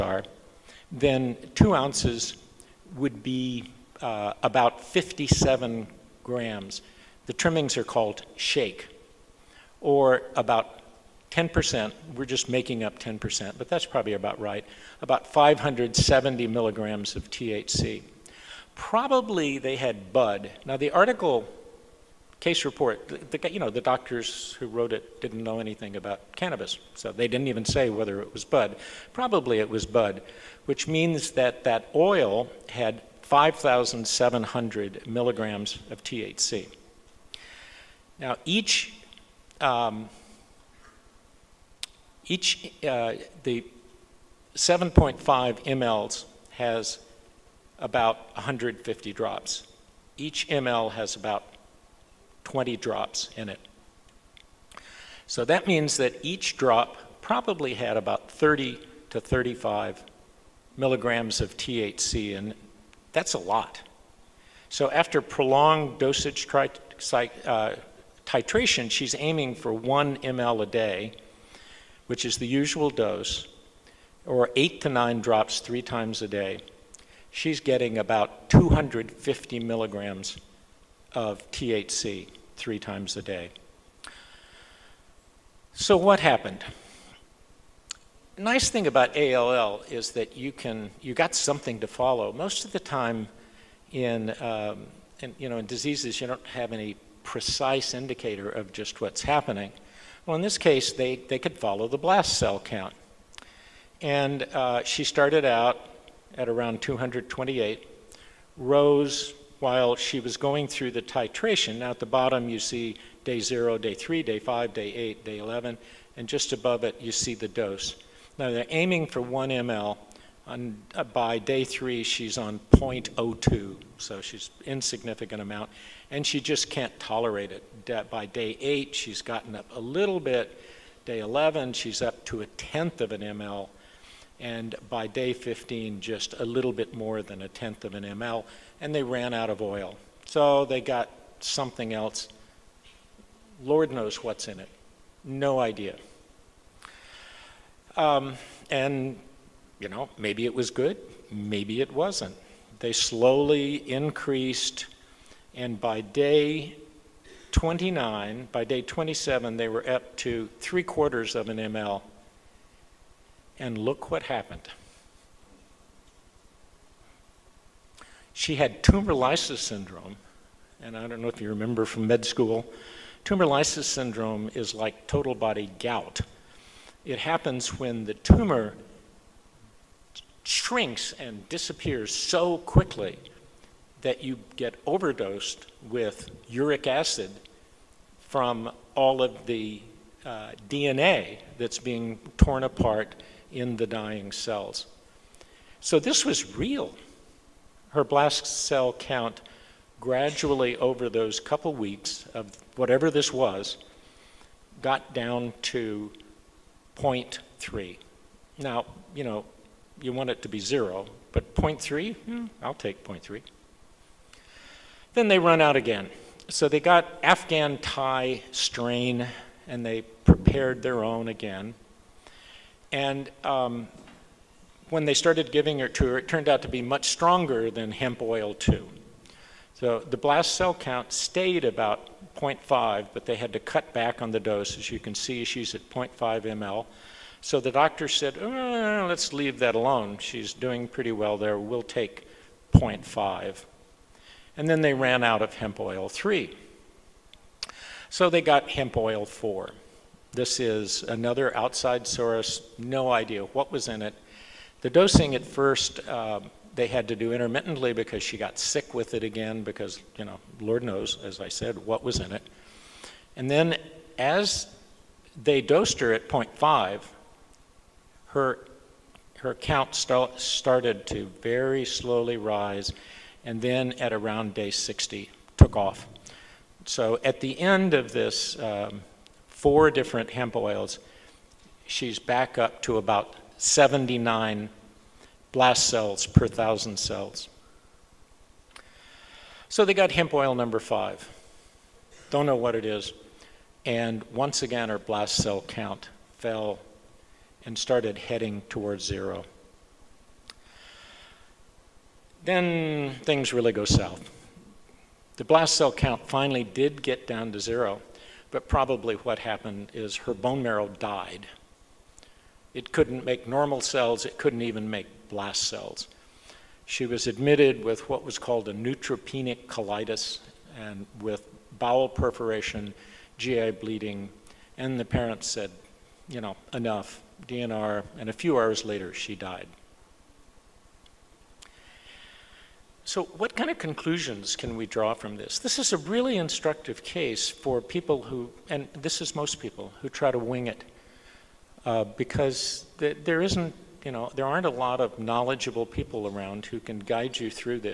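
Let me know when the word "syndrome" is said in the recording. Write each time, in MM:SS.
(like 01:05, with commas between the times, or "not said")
02:49, 02:53.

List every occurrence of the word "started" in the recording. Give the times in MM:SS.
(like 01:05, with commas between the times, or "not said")
01:45, 03:45, 04:30, 04:57.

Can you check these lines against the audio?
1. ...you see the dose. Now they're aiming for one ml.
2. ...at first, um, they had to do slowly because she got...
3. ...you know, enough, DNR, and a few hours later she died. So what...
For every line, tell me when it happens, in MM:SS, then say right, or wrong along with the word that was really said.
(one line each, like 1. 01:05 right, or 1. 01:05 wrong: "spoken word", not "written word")
1. 01:57 right
2. 04:15 wrong: "intermittently", not "slowly"
3. 05:26 right.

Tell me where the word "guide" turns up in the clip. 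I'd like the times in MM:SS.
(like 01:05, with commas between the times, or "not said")
05:46.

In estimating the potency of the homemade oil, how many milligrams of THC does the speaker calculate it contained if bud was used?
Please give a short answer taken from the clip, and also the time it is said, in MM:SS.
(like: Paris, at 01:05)
5,700 milligrams, at 00:33.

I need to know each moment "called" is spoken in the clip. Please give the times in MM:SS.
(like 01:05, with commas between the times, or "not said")
00:07, 05:18.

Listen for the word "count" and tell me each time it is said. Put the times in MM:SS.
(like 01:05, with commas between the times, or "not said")
01:42, 03:18, 03:50, 04:29, 04:55, 05:05.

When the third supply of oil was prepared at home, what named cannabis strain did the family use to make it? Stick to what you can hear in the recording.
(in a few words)
Afghan Thai.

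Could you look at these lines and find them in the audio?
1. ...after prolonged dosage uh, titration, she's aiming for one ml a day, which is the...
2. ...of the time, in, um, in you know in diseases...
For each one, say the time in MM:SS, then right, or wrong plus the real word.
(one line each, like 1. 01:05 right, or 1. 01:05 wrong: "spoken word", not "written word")
1. 01:04 right
2. 01:32 right.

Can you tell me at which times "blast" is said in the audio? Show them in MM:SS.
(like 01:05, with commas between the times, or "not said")
01:41, 03:18, 03:50, 04:45, 04:54, 05:05, 05:15.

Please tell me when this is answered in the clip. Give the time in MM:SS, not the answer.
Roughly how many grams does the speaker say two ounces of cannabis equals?
00:04.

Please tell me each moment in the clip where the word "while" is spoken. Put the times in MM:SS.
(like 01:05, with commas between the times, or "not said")
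01:49.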